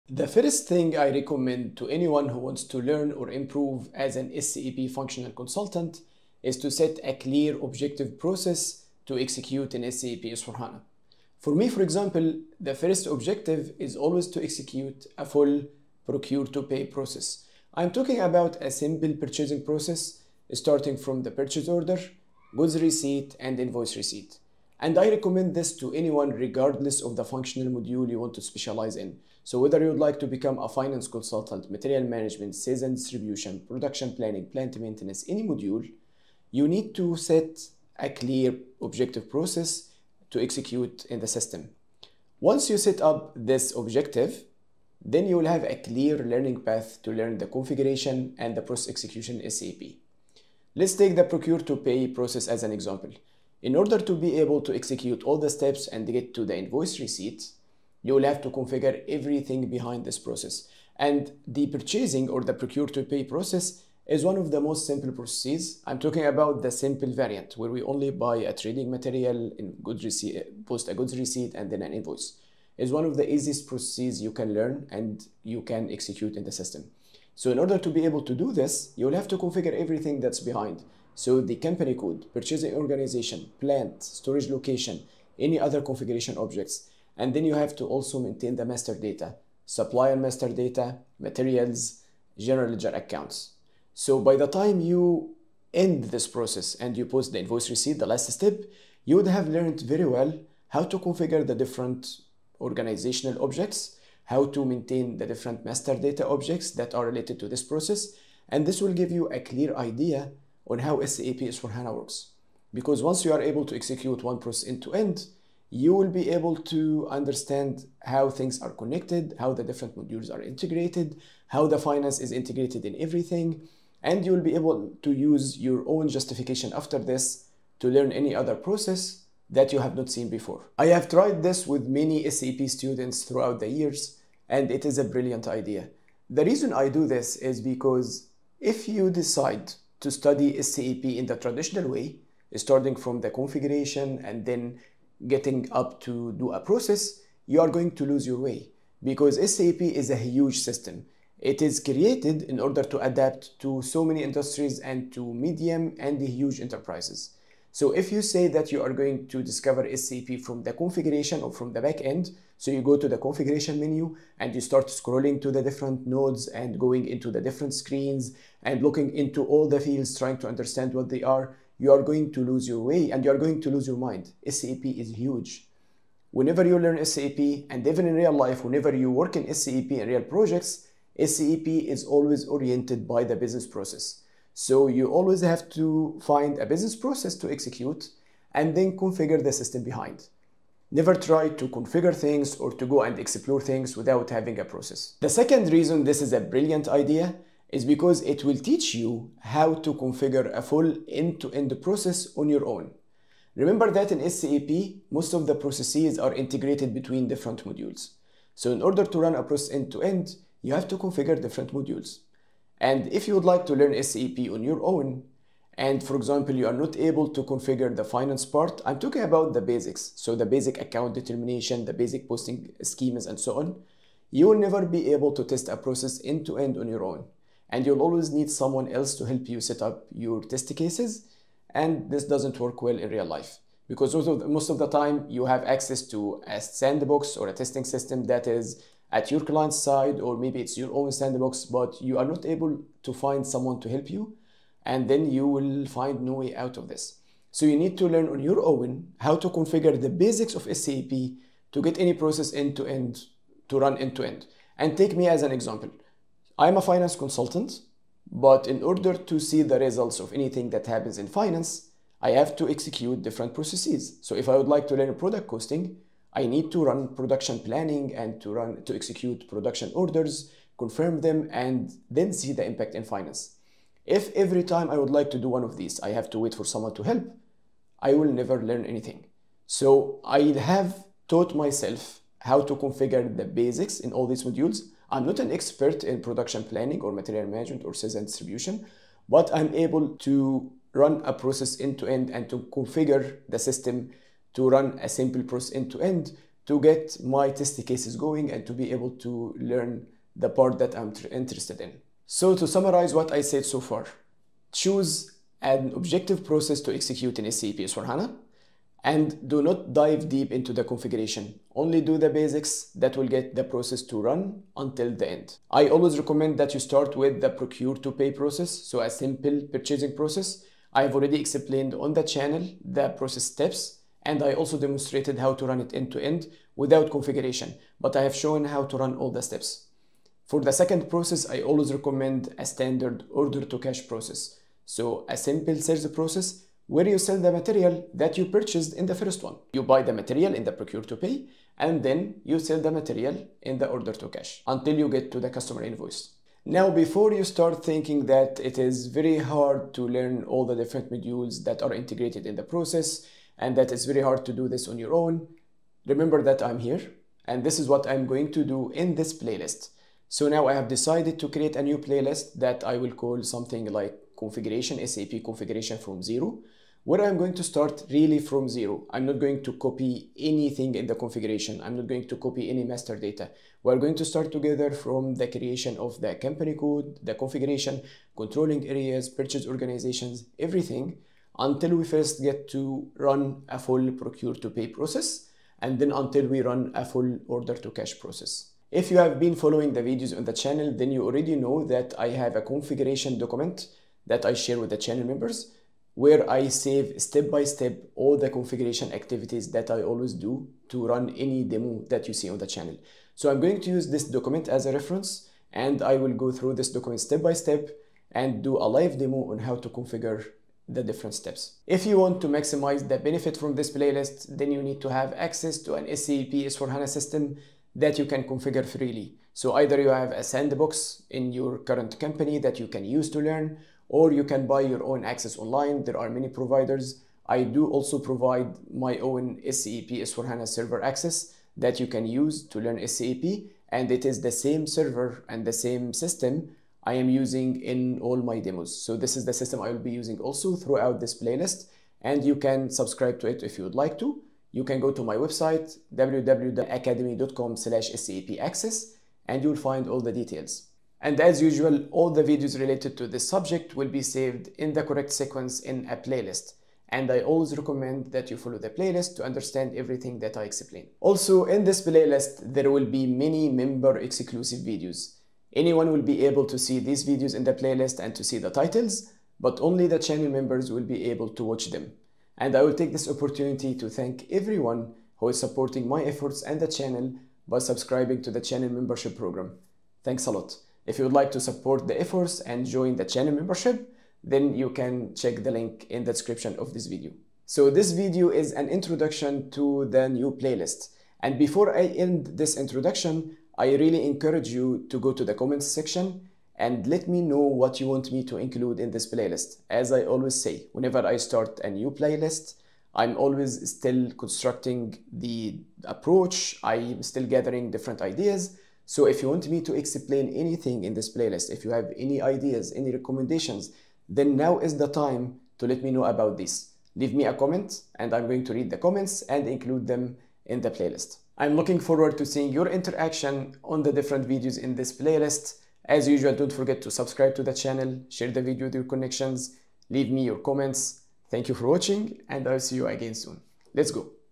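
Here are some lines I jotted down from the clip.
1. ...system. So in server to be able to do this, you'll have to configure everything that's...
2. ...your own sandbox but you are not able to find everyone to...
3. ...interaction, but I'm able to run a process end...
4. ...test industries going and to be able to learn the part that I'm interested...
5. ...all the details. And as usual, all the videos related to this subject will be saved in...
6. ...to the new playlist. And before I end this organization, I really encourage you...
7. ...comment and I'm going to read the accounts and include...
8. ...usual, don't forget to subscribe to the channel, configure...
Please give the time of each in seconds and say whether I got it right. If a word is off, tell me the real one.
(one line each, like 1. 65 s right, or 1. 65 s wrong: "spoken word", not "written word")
1. 76 s wrong: "order", not "server"
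2. 240 s wrong: "someone", not "everyone"
3. 288 s wrong: "distribution", not "interaction"
4. 297 s wrong: "cases", not "industries"
5. 450 s right
6. 489 s wrong: "introduction", not "organization"
7. 517 s wrong: "comments", not "accounts"
8. 526 s wrong: "share", not "configure".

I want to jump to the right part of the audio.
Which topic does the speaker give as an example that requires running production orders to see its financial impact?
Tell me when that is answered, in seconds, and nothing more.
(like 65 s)
265 s.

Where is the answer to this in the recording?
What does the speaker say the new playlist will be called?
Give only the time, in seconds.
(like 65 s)
365 s.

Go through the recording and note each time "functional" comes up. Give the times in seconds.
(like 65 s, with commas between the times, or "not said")
4 s, 27 s.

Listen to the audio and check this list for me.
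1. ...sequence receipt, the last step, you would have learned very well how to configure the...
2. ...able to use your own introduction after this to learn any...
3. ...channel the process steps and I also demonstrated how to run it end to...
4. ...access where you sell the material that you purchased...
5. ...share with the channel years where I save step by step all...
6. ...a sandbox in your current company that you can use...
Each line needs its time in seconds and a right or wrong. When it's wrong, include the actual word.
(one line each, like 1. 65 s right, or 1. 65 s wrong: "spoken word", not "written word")
1. 97 s wrong: "invoice", not "sequence"
2. 124 s wrong: "justification", not "introduction"
3. 322 s right
4. 336 s wrong: "process", not "access"
5. 394 s wrong: "members", not "years"
6. 420 s right.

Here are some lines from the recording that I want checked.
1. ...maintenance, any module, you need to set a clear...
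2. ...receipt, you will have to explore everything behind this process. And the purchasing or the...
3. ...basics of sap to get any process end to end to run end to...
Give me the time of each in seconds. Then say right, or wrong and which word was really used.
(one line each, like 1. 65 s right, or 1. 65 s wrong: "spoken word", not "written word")
1. 34 s right
2. 56 s wrong: "configure", not "explore"
3. 250 s right.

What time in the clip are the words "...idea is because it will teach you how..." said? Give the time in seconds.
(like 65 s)
196 s.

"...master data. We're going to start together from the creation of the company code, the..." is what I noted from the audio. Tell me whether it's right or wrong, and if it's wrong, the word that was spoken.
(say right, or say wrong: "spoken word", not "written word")
right.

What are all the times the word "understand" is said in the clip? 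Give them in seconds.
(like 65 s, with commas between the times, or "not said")
117 s, 170 s, 459 s.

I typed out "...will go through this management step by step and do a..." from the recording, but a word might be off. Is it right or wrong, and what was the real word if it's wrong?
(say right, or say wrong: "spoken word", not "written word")
wrong: "document", not "management".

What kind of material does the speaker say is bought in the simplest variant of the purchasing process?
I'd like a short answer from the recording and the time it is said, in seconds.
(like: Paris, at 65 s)
Trading material, at 68 s.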